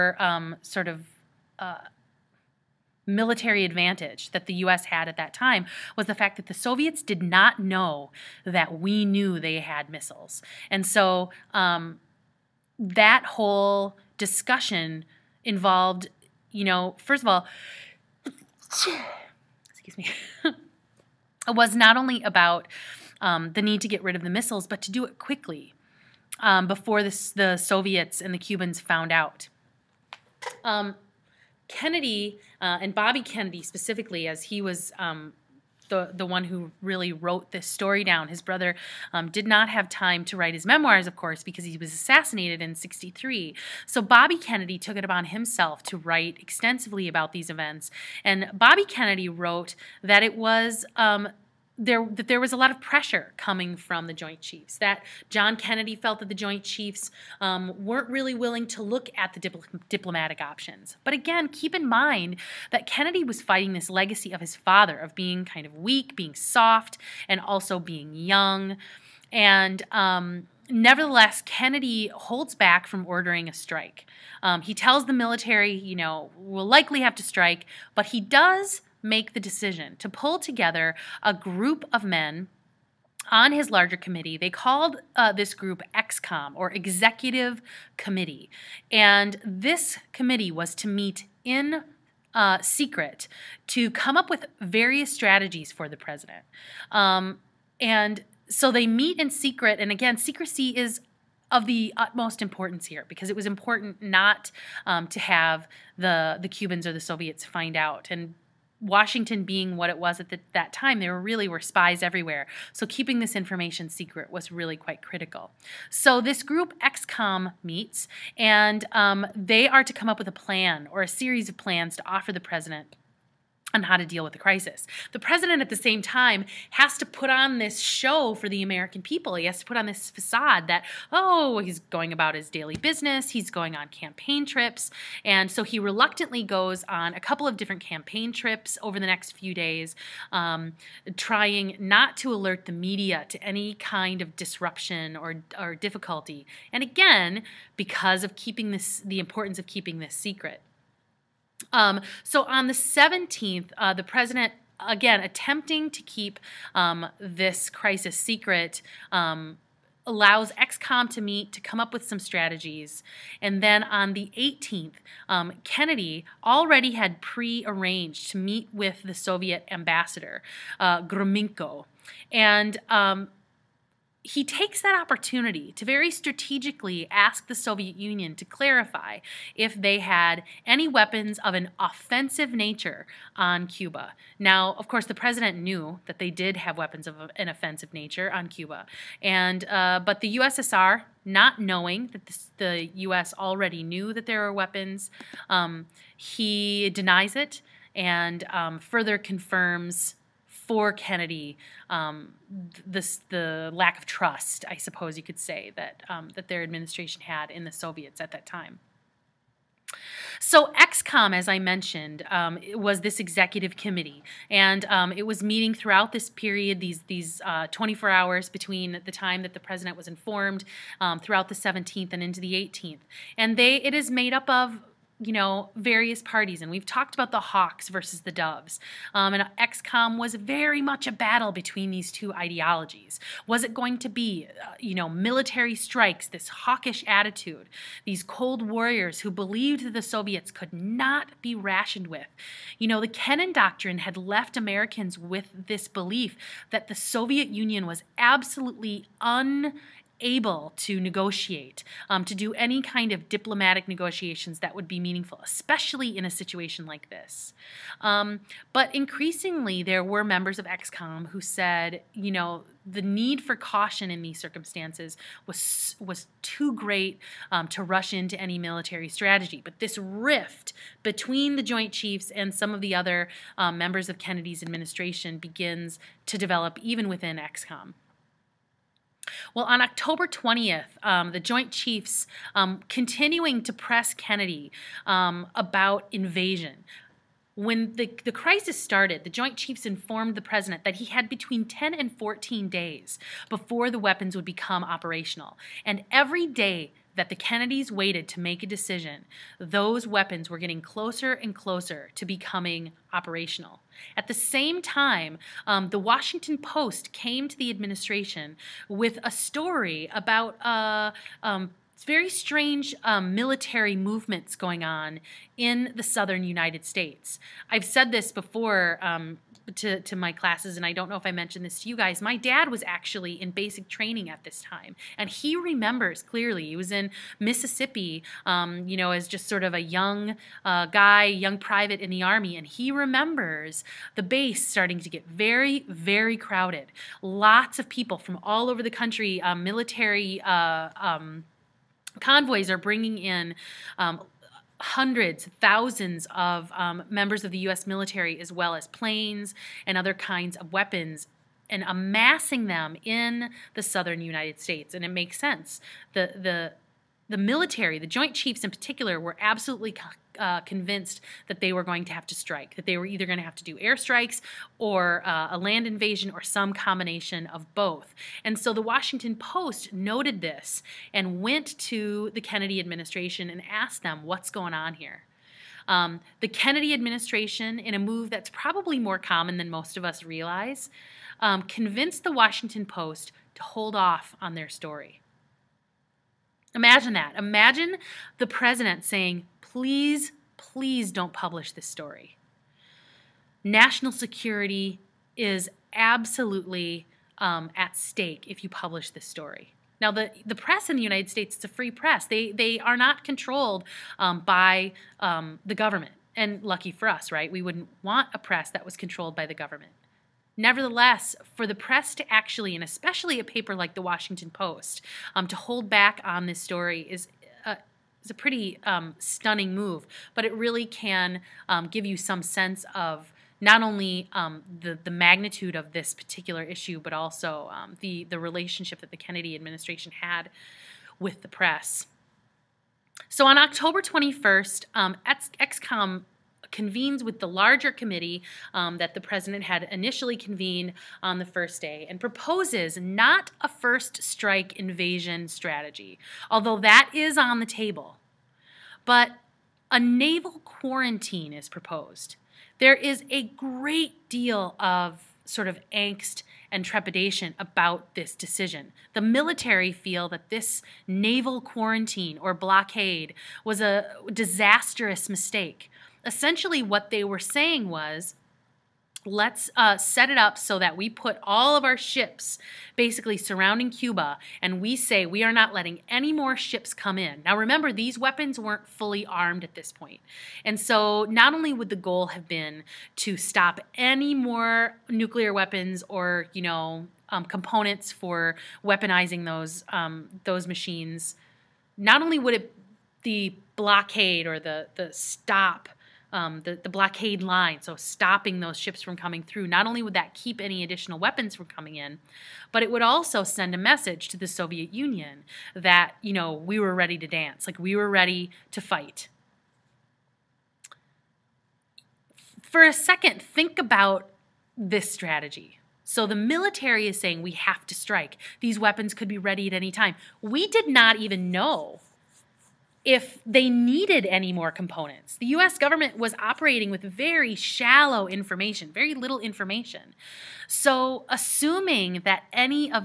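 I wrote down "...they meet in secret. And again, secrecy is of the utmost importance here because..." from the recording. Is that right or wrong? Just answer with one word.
right.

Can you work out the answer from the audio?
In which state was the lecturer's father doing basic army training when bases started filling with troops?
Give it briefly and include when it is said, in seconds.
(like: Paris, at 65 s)
Mississippi, at 327 s.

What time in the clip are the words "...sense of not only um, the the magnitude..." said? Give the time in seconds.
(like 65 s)
422 s.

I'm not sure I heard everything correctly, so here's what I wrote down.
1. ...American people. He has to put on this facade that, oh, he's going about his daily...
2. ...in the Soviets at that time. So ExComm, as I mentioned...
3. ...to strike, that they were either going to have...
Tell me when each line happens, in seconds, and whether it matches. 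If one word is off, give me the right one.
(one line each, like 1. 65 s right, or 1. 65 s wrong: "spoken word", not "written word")
1. 128 s right
2. 207 s right
3. 362 s right.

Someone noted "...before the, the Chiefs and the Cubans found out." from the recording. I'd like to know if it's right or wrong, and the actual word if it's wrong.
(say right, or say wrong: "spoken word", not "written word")
wrong: "Soviets", not "Chiefs".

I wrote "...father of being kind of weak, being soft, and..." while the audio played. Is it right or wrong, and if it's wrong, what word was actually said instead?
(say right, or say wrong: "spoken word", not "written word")
right.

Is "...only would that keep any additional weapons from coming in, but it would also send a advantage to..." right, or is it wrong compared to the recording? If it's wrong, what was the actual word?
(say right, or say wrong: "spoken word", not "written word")
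wrong: "message", not "advantage".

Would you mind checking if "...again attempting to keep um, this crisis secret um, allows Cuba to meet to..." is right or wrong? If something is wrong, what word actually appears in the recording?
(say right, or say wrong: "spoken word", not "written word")
wrong: "ExComm", not "Cuba".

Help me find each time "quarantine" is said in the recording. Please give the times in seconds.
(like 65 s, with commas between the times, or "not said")
450 s, 461 s.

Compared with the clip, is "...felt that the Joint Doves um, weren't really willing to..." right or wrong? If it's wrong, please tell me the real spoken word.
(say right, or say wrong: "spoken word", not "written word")
wrong: "Chiefs", not "Doves".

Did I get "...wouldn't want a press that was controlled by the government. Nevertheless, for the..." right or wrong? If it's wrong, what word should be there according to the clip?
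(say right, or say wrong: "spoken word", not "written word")
right.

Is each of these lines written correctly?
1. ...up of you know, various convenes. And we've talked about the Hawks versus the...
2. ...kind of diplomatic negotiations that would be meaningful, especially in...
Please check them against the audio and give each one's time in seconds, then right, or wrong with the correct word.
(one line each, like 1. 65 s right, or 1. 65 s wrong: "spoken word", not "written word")
1. 224 s wrong: "parties", not "convenes"
2. 252 s right.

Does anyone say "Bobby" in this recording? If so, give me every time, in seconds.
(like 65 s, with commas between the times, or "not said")
32 s, 44 s, 48 s.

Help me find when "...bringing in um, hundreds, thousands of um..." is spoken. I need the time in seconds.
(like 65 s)
342 s.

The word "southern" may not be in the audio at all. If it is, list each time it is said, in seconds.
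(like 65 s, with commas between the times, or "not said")
316 s, 353 s.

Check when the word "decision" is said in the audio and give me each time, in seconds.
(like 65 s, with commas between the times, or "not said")
79 s, 298 s, 458 s.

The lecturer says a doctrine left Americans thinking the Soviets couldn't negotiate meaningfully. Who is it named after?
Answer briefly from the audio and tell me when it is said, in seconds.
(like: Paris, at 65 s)
Kennan, at 243 s.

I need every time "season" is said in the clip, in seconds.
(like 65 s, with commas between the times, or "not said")
not said.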